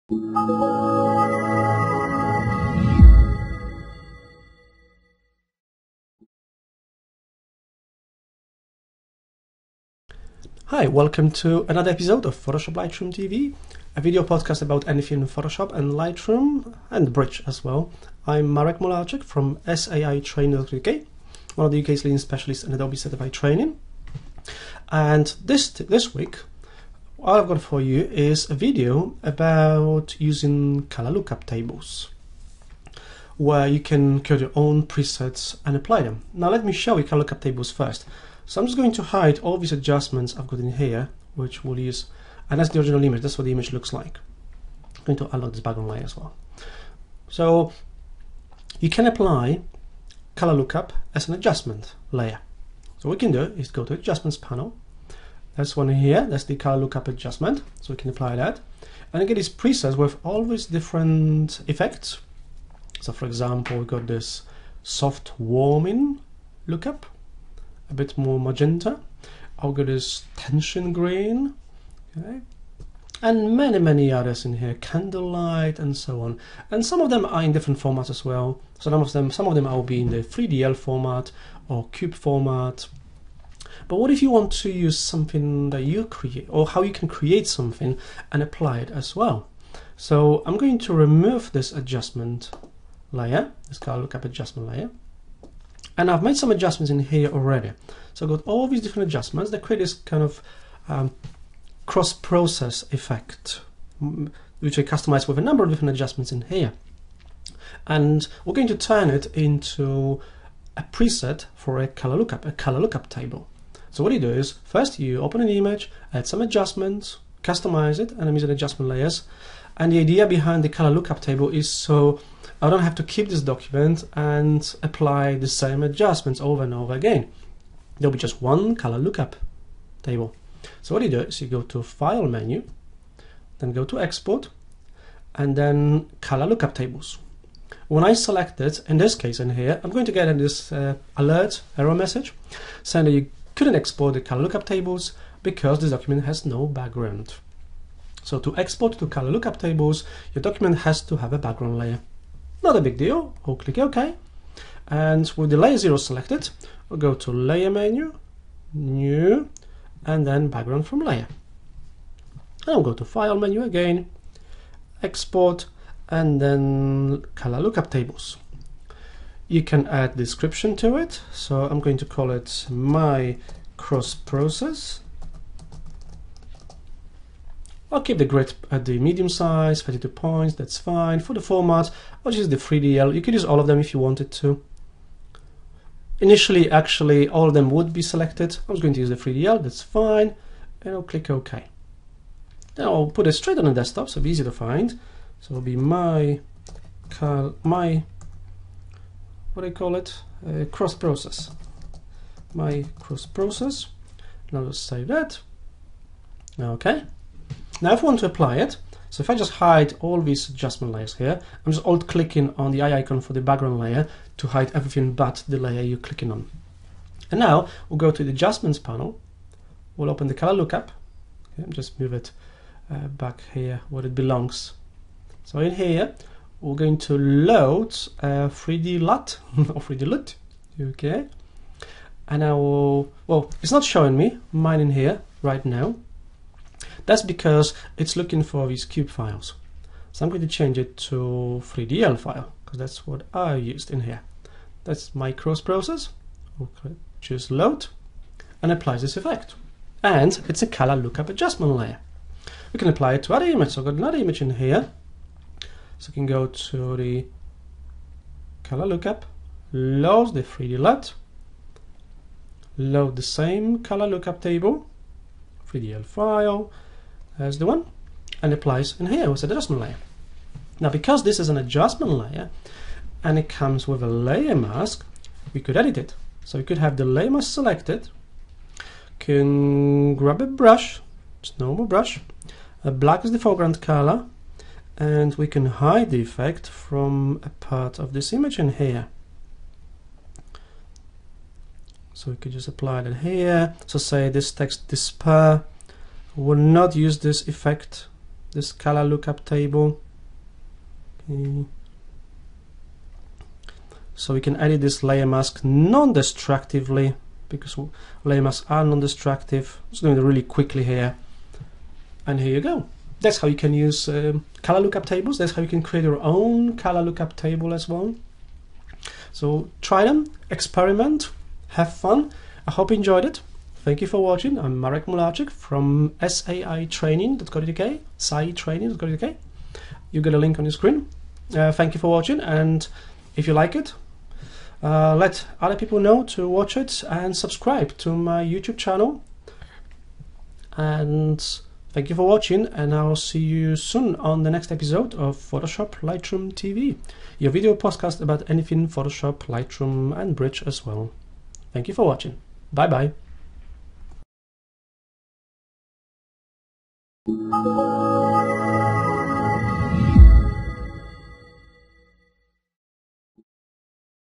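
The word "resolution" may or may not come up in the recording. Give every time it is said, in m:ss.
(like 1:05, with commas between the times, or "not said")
not said.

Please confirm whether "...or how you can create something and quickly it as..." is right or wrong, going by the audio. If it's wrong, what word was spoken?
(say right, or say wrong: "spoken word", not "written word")
wrong: "apply", not "quickly".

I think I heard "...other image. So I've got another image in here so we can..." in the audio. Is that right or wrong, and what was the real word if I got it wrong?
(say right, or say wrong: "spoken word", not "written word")
right.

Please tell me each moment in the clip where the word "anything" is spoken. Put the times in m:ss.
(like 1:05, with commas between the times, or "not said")
0:14, 5:48.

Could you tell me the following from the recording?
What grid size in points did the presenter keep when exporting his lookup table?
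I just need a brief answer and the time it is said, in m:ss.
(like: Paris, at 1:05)
32, at 2:59.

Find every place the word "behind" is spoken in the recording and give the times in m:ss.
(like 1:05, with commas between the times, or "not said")
2:00.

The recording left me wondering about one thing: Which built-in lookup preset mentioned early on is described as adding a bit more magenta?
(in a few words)
soft warming.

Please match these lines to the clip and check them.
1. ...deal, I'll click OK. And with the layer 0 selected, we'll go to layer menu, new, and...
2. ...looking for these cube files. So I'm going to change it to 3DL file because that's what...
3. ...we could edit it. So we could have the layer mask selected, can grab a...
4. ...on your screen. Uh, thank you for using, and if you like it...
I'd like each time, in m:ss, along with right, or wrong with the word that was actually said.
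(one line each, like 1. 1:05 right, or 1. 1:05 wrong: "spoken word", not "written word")
1. 2:32 right
2. 3:58 right
3. 4:35 right
4. 5:30 wrong: "watching", not "using".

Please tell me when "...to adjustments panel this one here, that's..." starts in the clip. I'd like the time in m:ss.
0:53.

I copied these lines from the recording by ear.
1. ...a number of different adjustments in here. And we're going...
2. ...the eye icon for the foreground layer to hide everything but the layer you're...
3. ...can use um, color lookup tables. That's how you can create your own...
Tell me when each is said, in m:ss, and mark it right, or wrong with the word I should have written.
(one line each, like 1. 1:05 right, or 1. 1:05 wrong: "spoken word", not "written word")
1. 1:45 right
2. 3:32 wrong: "background", not "foreground"
3. 5:13 right.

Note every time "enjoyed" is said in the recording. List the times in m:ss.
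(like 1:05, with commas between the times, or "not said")
5:22.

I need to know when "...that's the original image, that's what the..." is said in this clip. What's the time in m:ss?
0:42.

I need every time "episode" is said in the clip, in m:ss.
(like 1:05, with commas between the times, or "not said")
0:11, 5:44.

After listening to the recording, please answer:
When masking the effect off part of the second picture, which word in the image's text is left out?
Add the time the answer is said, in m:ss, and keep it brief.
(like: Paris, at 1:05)
despair, at 4:54.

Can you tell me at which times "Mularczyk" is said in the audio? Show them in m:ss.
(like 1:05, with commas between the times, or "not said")
0:18, 5:25.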